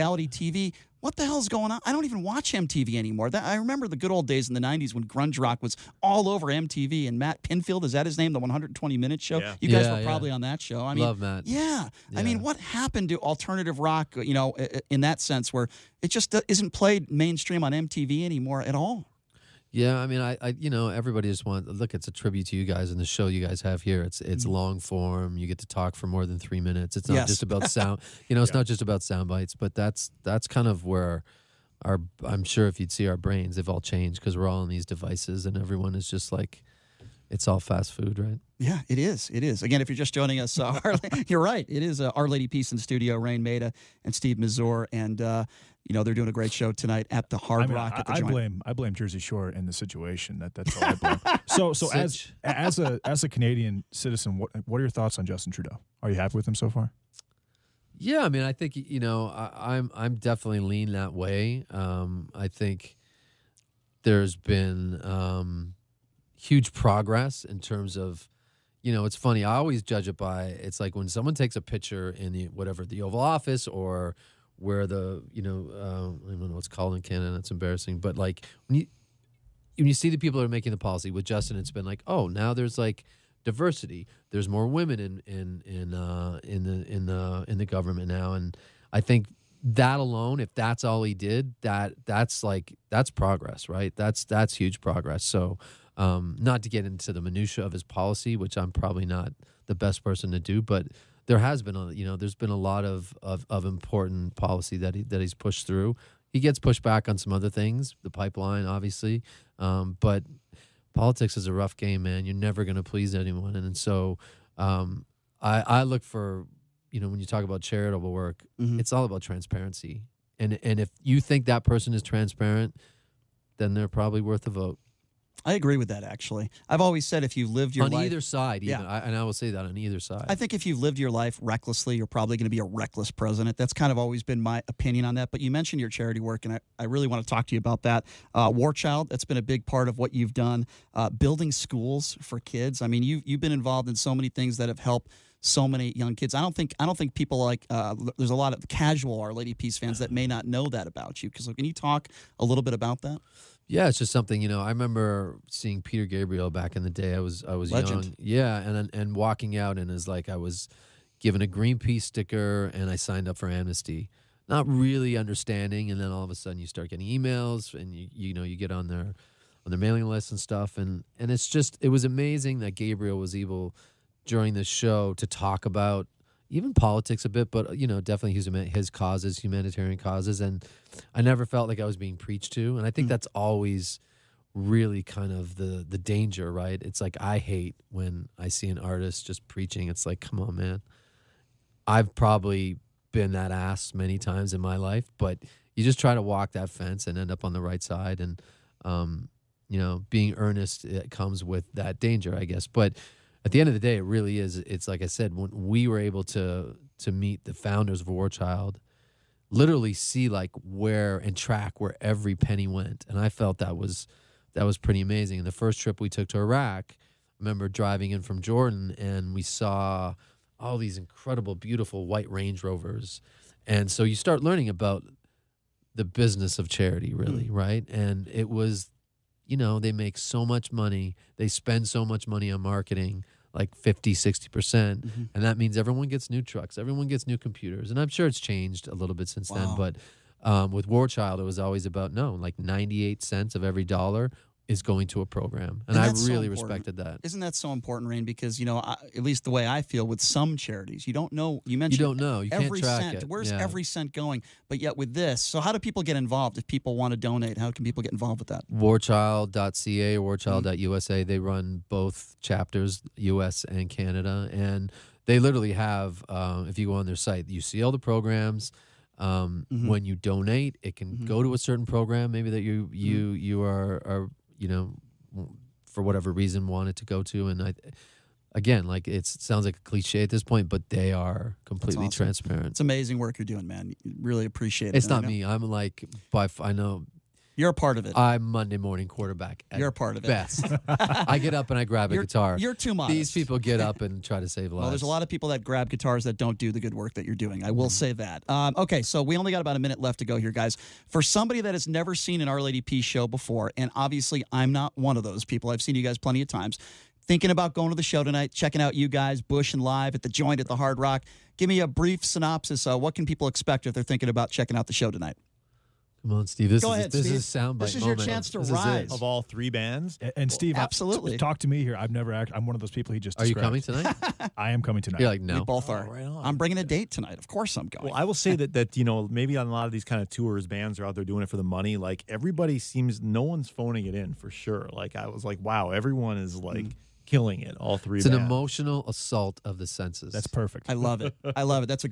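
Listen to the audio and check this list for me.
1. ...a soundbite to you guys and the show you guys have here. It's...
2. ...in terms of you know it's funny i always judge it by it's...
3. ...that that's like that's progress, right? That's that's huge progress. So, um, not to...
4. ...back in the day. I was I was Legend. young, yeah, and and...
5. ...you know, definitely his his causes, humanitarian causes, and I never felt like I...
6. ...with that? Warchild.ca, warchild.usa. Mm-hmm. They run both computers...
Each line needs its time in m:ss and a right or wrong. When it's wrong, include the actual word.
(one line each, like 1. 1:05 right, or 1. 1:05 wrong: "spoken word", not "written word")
1. 0:22 wrong: "tribute", not "soundbite"
2. 1:07 right
3. 1:31 right
4. 2:36 right
5. 2:57 right
6. 4:18 wrong: "chapters", not "computers".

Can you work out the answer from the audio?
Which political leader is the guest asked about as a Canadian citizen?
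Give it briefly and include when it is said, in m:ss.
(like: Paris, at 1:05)
Justin Trudeau, at 0:55.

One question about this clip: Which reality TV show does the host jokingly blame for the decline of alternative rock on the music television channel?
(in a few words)
Jersey Shore.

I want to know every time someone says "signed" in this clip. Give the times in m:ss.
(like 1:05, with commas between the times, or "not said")
2:42.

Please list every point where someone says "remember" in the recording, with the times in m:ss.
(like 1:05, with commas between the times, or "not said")
0:03, 2:34, 3:37.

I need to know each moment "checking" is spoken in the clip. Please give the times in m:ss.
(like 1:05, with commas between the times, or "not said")
5:08, 5:14.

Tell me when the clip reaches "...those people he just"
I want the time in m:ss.
5:22.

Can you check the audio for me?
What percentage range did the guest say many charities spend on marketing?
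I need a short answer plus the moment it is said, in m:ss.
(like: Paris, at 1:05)
50 to 60%, at 3:53.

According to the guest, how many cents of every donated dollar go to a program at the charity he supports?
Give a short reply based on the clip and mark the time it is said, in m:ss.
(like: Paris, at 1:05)
98, at 4:02.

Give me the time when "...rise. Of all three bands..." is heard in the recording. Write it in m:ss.
5:18.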